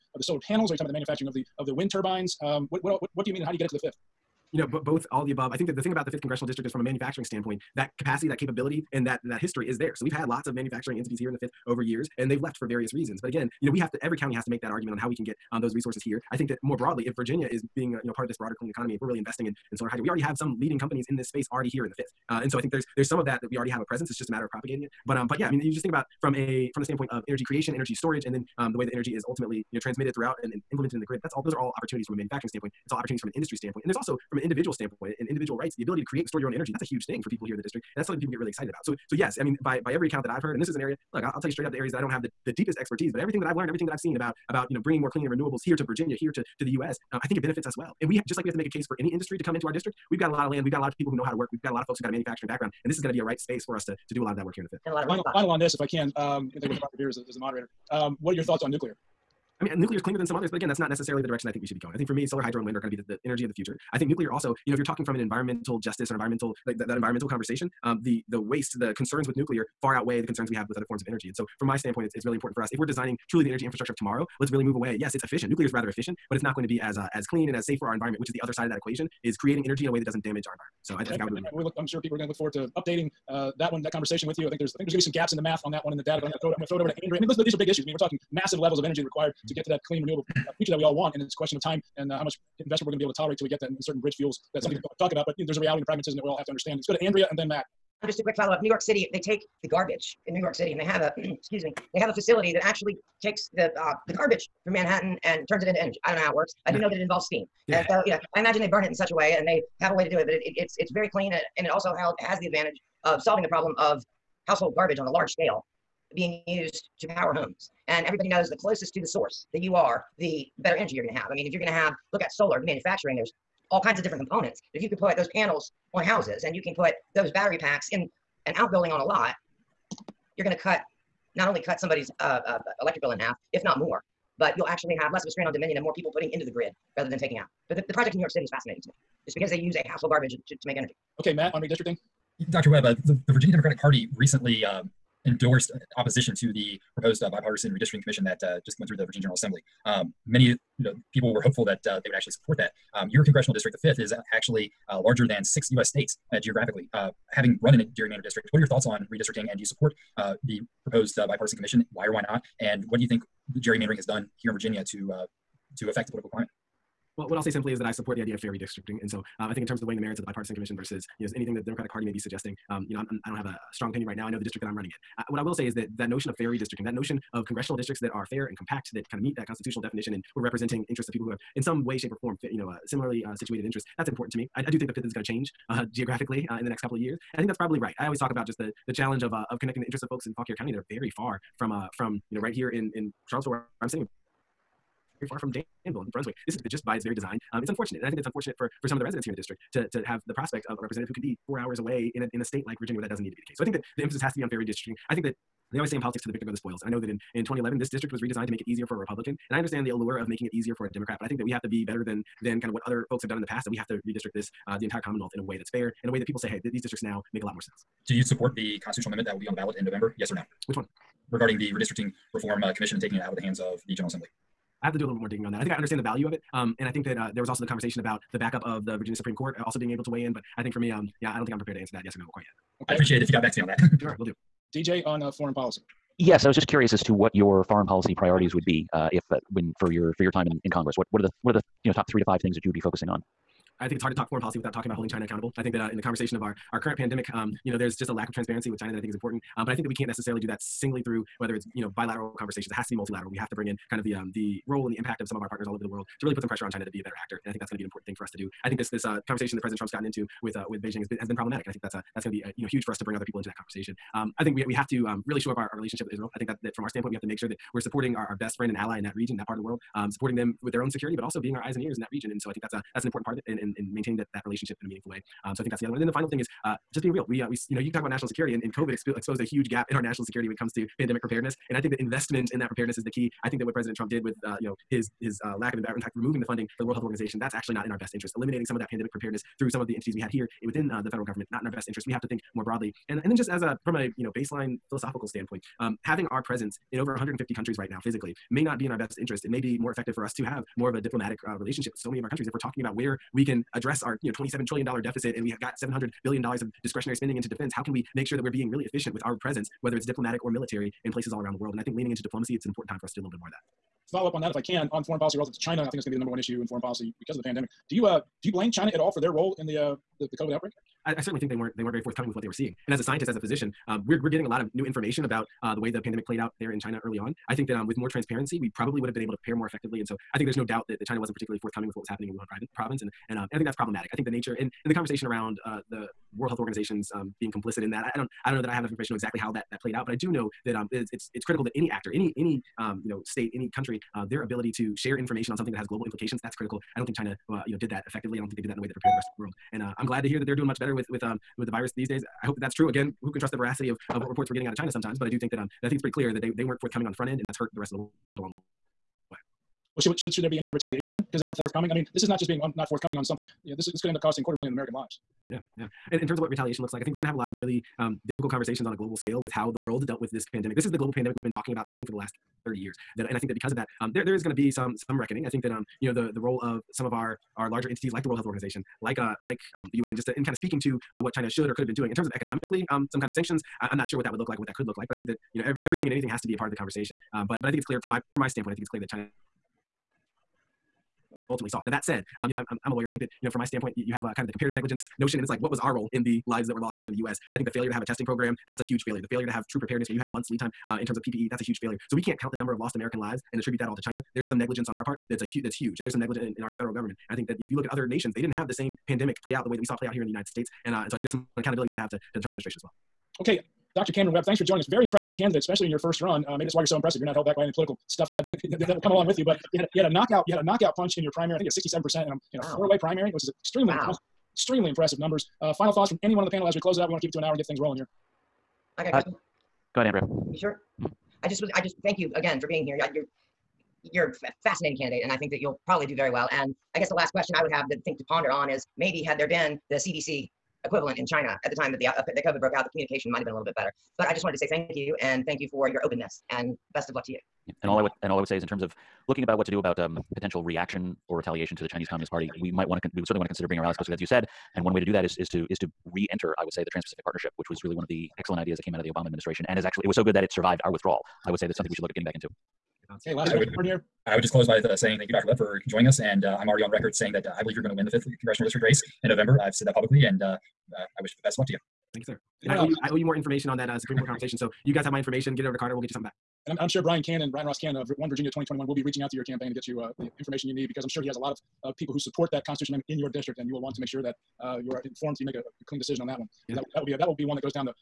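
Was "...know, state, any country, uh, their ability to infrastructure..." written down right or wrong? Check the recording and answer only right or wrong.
wrong.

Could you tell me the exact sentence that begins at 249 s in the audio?
Um, but I think that we can't necessarily do that singly through whether it's you know bilateral conversations.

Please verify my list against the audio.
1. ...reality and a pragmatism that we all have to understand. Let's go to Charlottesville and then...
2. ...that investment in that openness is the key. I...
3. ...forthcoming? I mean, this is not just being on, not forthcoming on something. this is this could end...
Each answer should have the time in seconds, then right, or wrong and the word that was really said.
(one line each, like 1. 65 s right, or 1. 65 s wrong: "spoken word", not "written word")
1. 95 s wrong: "Andrea", not "Charlottesville"
2. 281 s wrong: "preparedness", not "openness"
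3. 361 s right.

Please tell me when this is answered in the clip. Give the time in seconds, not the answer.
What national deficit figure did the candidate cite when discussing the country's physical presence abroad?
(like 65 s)
304 s.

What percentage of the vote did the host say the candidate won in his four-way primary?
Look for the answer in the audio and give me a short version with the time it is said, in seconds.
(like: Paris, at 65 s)
67 percent, at 421 s.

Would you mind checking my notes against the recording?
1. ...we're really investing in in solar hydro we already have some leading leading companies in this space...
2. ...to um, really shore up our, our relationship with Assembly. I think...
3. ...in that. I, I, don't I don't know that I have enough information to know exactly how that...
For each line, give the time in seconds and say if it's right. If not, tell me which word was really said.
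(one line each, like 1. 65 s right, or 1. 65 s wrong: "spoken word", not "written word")
1. 19 s right
2. 264 s wrong: "Israel", not "Assembly"
3. 337 s right.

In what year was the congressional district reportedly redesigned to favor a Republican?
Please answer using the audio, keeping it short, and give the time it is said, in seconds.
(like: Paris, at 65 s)
2011, at 207 s.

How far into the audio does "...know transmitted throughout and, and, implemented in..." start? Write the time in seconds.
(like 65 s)
29 s.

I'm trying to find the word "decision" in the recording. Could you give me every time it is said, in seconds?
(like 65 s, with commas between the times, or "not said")
485 s.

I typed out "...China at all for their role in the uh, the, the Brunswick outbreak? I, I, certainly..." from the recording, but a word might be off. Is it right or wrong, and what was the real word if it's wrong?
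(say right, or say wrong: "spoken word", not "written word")
wrong: "COVID", not "Brunswick".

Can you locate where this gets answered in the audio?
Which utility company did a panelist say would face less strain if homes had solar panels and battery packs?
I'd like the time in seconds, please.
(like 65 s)
135 s.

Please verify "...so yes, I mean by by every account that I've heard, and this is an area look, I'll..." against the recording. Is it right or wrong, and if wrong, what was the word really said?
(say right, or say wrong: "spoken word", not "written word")
right.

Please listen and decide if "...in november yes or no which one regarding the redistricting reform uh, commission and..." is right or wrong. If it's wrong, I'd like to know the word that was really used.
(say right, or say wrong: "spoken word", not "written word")
right.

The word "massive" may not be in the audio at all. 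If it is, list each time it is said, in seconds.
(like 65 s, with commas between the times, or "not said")
88 s.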